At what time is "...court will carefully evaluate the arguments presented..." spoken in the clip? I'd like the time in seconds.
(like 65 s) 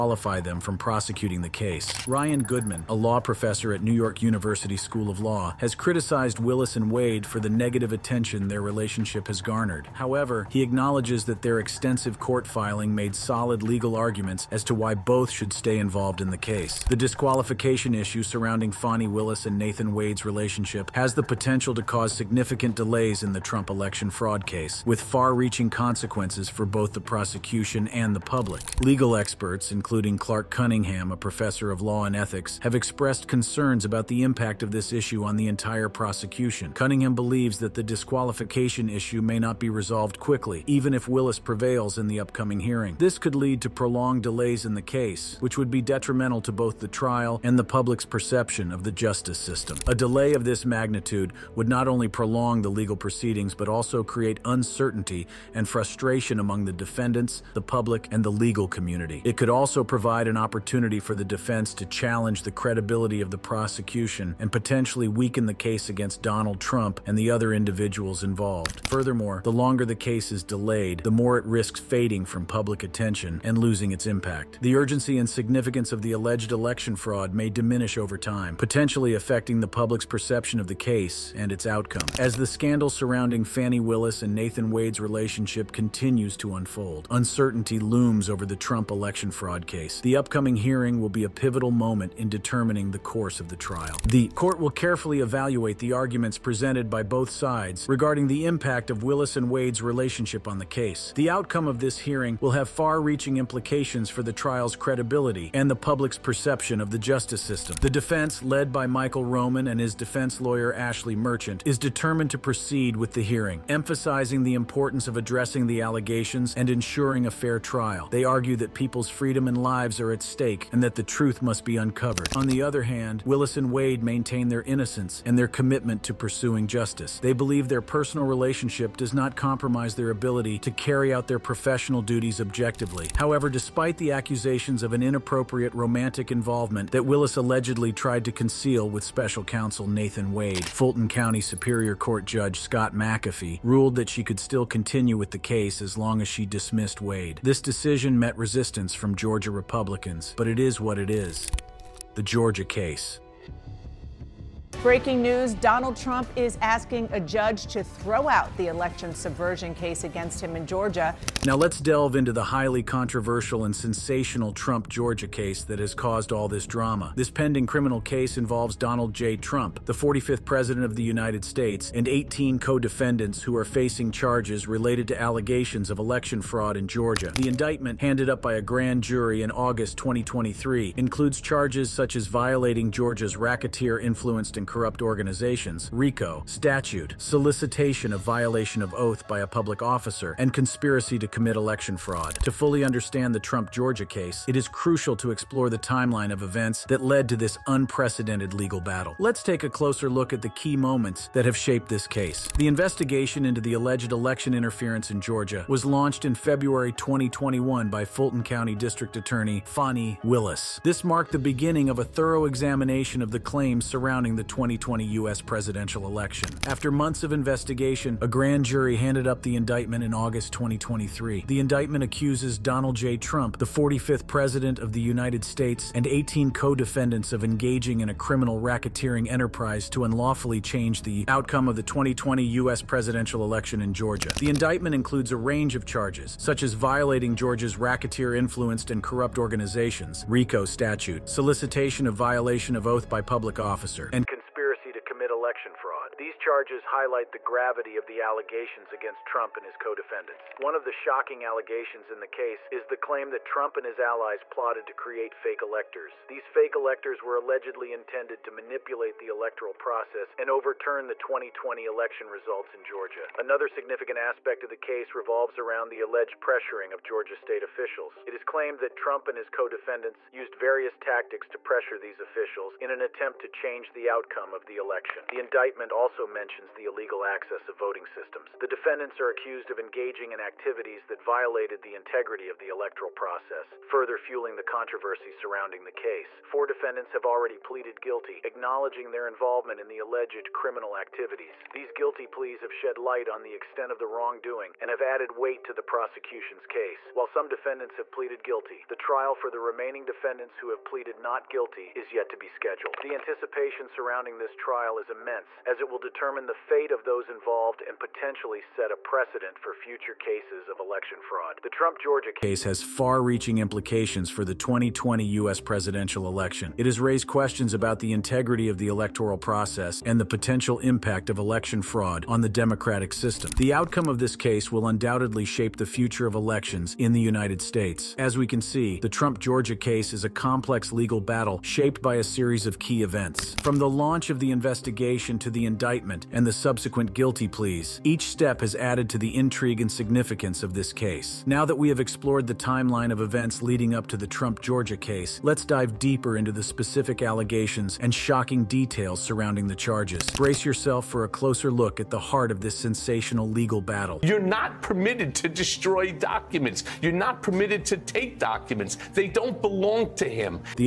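94 s.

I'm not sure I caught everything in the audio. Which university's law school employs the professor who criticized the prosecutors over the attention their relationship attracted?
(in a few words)
New York University.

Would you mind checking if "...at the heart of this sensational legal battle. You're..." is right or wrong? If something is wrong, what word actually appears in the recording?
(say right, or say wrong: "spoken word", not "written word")
right.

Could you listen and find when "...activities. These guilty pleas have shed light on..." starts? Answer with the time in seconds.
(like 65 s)
290 s.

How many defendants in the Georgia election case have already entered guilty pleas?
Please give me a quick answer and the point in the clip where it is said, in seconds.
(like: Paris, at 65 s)
4, at 286 s.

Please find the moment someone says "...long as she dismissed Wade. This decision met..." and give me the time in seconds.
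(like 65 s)
145 s.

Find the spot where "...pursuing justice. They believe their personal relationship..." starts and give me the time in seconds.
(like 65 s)
126 s.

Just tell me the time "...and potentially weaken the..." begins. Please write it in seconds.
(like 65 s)
64 s.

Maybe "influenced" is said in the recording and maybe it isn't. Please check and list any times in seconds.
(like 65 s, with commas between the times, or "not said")
184 s, 237 s.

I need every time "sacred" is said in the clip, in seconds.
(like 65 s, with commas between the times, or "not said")
not said.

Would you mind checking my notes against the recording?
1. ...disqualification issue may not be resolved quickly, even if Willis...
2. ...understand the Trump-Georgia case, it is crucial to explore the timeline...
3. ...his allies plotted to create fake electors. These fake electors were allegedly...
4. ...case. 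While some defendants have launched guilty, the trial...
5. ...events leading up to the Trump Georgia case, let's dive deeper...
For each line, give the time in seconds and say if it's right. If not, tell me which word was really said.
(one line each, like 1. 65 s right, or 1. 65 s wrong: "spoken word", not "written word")
1. 37 s right
2. 192 s right
3. 253 s right
4. 296 s wrong: "pleaded", not "launched"
5. 343 s right.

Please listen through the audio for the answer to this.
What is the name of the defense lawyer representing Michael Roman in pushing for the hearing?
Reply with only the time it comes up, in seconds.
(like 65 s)
110 s.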